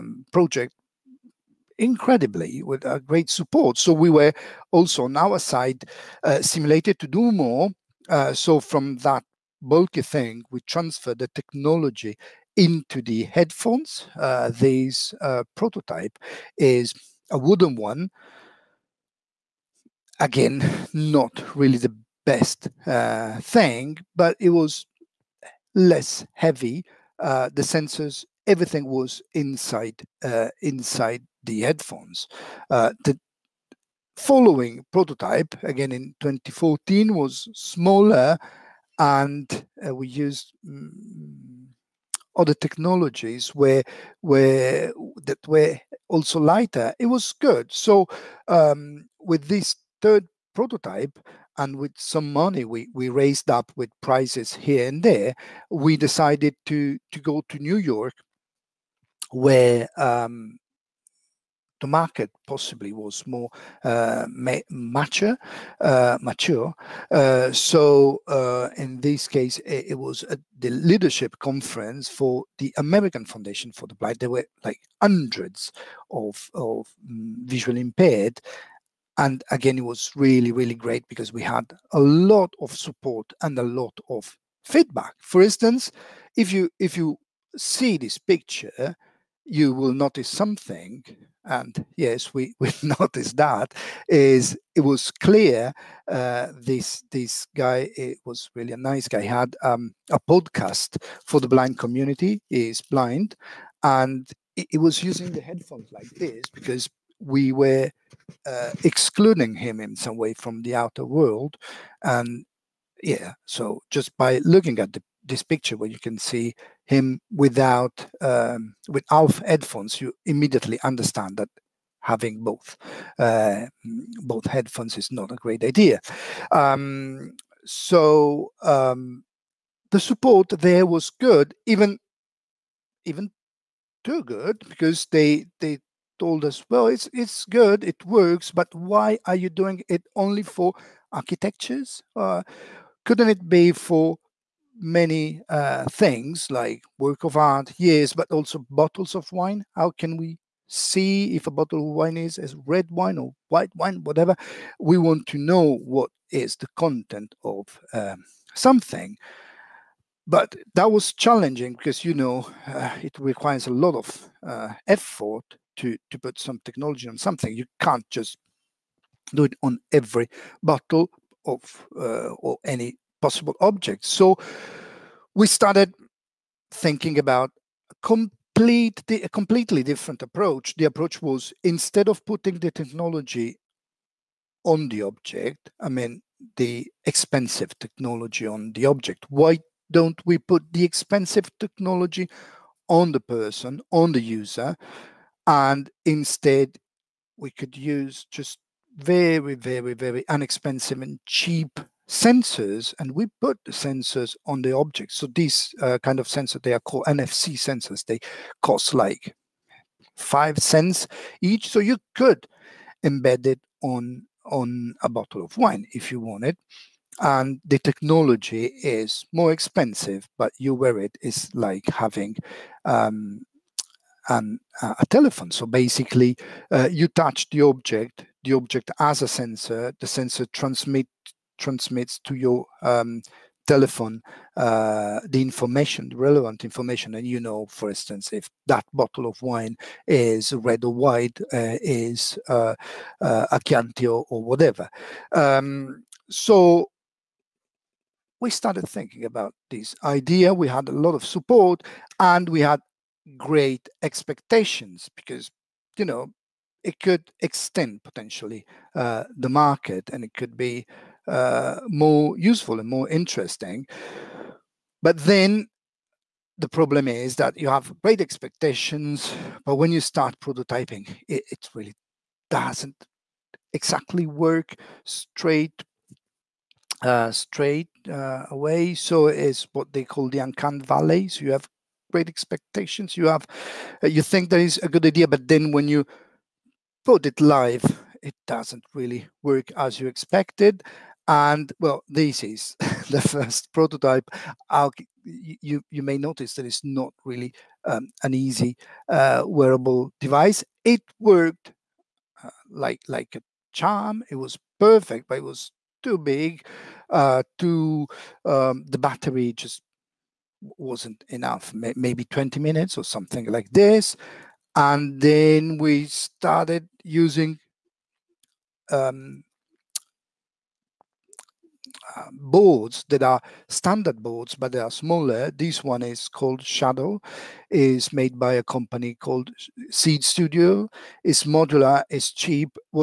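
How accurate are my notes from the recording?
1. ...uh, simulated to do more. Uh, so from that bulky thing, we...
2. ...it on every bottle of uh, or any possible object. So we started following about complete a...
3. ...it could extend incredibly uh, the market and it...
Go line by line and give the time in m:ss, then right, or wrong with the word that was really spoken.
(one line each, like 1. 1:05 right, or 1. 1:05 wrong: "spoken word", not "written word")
1. 0:06 right
2. 2:49 wrong: "thinking", not "following"
3. 4:16 wrong: "potentially", not "incredibly".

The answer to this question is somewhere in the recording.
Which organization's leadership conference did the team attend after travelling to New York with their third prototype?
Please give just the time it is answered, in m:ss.
1:12.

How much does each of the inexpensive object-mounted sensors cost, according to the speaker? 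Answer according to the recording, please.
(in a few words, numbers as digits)
5 cents.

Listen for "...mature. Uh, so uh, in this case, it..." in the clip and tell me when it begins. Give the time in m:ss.
1:06.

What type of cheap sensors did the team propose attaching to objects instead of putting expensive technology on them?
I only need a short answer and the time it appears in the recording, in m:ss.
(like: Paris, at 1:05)
NFC, at 3:27.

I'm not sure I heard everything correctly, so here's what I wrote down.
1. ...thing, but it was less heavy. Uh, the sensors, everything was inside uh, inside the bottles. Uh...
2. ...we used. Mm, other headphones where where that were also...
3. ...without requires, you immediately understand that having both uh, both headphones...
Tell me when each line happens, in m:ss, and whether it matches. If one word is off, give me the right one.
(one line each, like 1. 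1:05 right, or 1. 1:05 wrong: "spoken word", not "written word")
1. 0:23 wrong: "headphones", not "bottles"
2. 0:39 wrong: "technologies", not "headphones"
3. 1:58 wrong: "headphones", not "requires".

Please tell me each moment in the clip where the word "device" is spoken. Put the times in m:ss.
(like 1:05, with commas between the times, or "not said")
5:00.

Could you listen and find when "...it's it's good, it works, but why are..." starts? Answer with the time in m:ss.
2:16.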